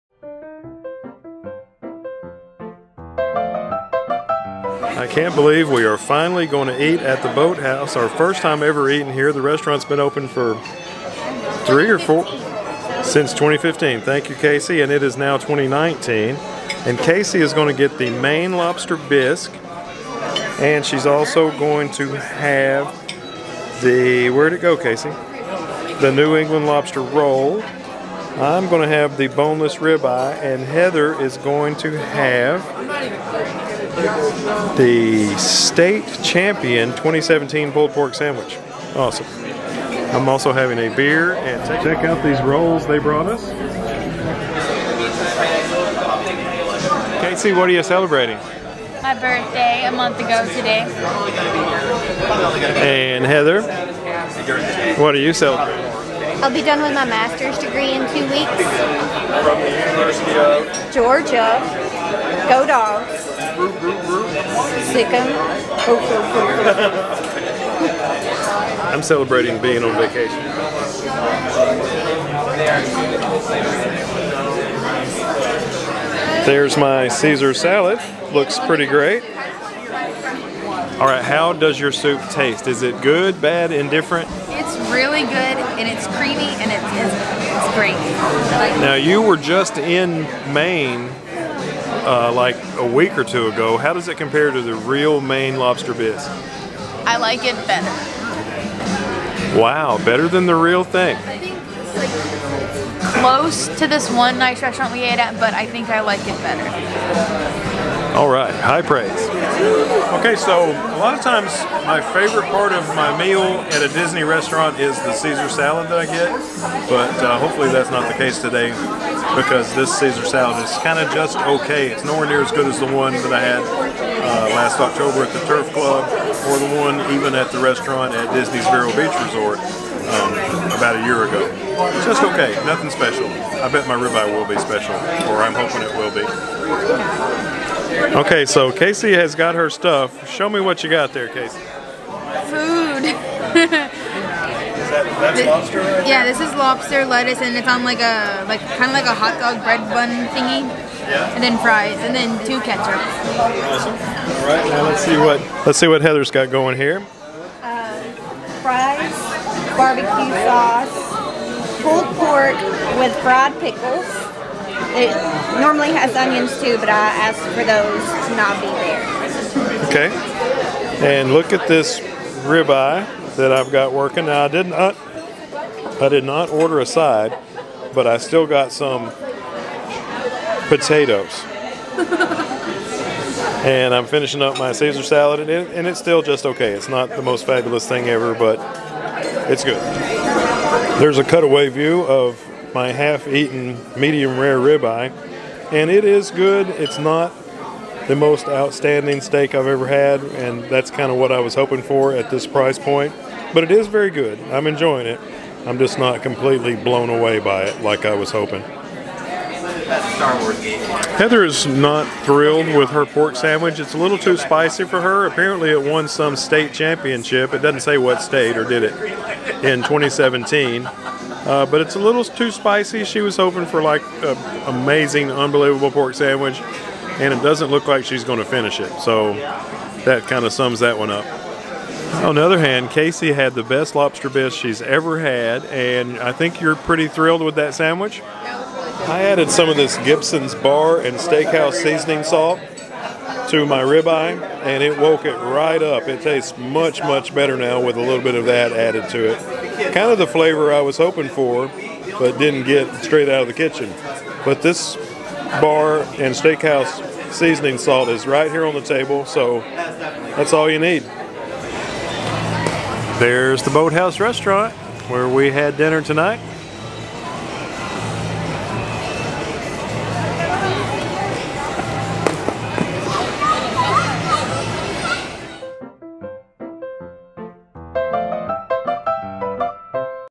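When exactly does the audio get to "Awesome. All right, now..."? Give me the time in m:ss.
2:32.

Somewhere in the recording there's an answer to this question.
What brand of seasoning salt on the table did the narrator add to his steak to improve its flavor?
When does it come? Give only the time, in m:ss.
3:59.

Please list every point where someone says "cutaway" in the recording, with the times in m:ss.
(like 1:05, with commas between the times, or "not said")
3:11.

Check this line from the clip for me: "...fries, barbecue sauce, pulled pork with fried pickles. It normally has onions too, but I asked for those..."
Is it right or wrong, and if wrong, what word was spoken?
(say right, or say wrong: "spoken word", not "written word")
right.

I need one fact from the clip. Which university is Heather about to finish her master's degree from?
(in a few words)
University of Georgia.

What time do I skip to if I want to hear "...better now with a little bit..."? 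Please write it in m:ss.
4:07.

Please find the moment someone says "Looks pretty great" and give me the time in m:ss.
1:18.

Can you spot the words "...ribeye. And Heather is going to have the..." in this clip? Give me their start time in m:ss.
0:29.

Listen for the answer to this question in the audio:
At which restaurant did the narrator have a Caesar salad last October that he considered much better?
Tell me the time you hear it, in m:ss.
2:05.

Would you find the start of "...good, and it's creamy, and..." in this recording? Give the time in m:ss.
1:25.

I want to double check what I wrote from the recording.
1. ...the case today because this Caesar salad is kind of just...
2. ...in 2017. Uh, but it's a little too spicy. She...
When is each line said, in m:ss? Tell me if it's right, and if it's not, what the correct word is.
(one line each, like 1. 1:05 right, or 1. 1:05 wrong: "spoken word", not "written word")
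1. 1:58 right
2. 3:39 right.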